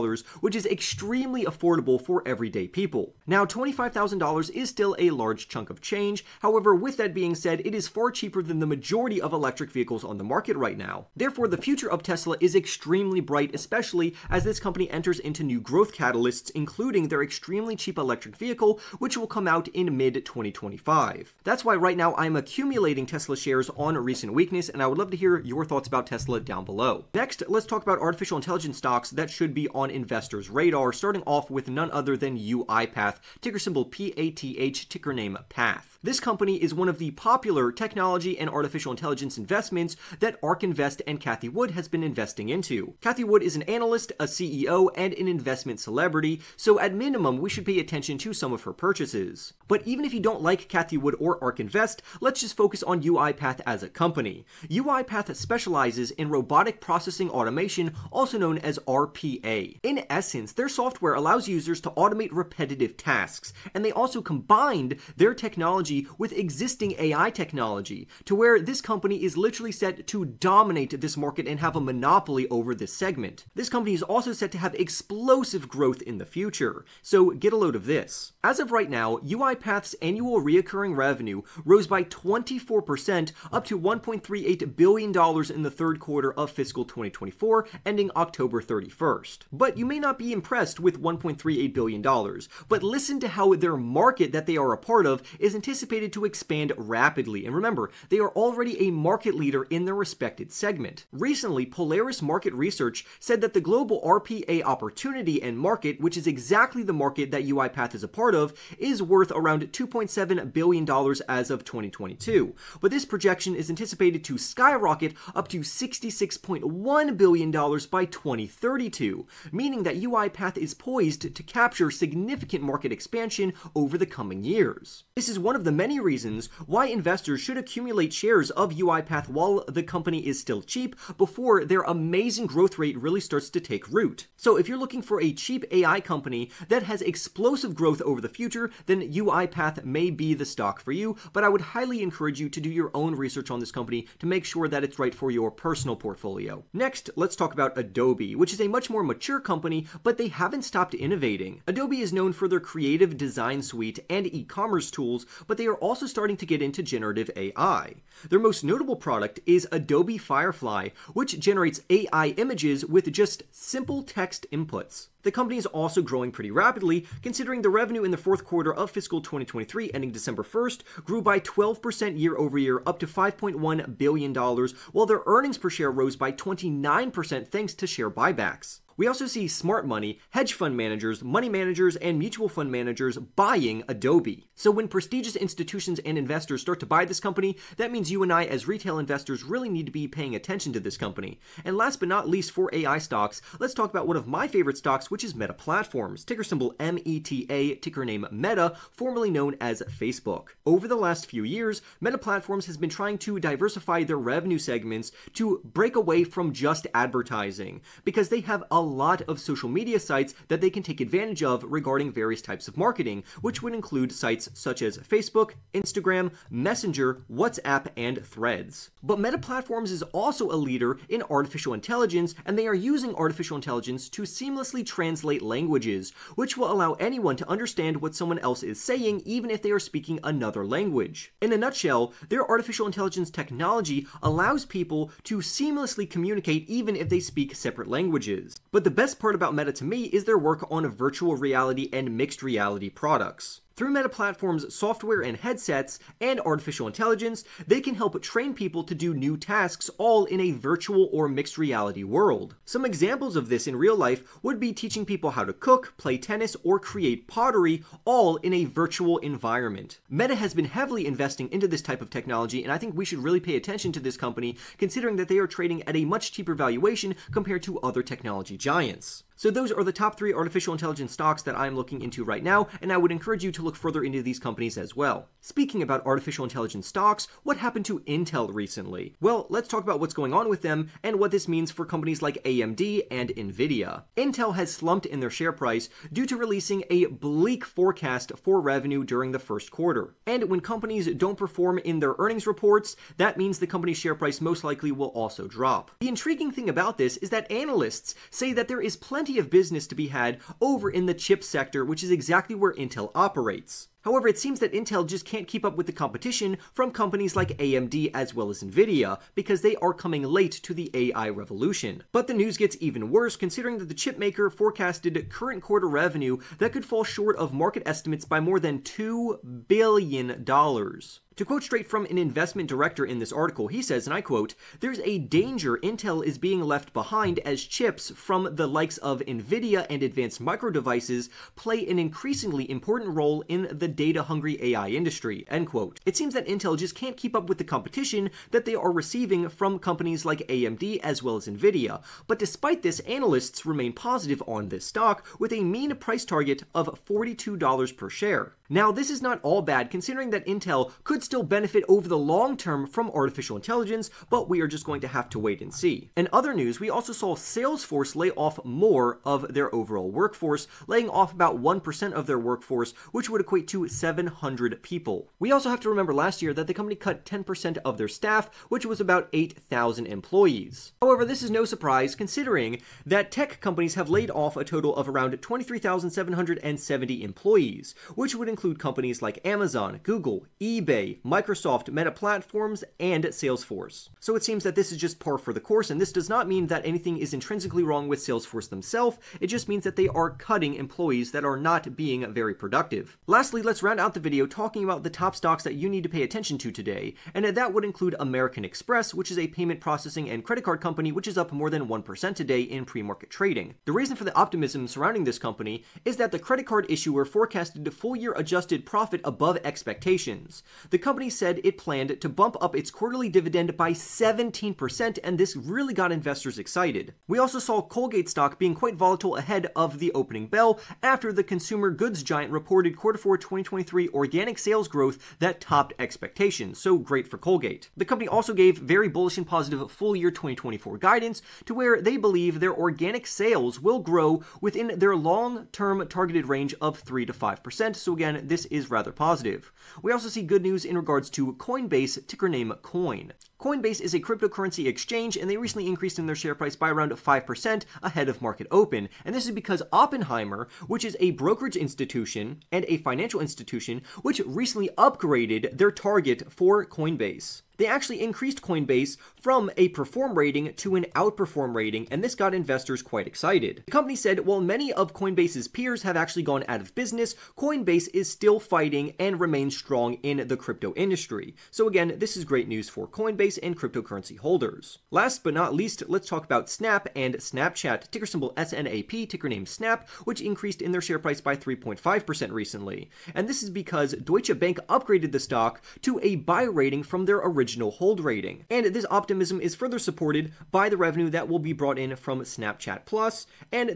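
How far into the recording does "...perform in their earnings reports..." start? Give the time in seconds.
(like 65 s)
291 s.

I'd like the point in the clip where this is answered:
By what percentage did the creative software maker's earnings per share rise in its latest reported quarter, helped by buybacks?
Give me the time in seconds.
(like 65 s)
176 s.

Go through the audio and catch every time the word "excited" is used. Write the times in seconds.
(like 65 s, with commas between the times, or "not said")
416 s, 463 s.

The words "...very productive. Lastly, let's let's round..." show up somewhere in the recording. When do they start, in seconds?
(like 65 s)
392 s.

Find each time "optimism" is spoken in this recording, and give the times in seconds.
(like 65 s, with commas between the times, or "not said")
404 s, 489 s.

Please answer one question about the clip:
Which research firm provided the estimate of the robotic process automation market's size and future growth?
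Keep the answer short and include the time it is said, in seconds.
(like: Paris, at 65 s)
Polaris Market Research, at 101 s.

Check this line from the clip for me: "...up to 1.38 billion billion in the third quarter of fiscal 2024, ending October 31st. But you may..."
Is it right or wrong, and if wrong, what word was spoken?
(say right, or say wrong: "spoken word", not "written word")
right.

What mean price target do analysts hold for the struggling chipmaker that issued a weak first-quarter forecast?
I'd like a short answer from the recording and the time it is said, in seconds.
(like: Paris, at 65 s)
$42 per share, at 347 s.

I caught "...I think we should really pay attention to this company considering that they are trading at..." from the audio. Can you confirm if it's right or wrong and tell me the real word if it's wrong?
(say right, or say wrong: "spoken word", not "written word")
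right.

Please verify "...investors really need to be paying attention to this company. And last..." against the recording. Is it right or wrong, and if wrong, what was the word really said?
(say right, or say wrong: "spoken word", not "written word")
right.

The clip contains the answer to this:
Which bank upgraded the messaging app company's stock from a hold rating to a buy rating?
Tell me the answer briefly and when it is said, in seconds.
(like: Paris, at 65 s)
Deutsche Bank, at 484 s.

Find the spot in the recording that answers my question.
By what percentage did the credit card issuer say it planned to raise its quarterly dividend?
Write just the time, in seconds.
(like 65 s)
413 s.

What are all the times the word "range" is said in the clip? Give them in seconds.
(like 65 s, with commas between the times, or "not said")
436 s.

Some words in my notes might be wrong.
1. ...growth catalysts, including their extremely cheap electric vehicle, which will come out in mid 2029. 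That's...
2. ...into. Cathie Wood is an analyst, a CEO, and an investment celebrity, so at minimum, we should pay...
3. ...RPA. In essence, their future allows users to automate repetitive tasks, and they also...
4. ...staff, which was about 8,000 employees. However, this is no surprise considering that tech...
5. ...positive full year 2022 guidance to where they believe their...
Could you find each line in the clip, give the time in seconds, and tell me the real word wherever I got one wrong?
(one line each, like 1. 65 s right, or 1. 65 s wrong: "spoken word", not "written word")
1. 15 s wrong: "2025", not "2029"
2. 42 s right
3. 58 s wrong: "software", not "future"
4. 368 s right
5. 429 s wrong: "2024", not "2022".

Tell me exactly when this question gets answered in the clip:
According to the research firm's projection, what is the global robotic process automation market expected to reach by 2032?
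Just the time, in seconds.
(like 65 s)
115 s.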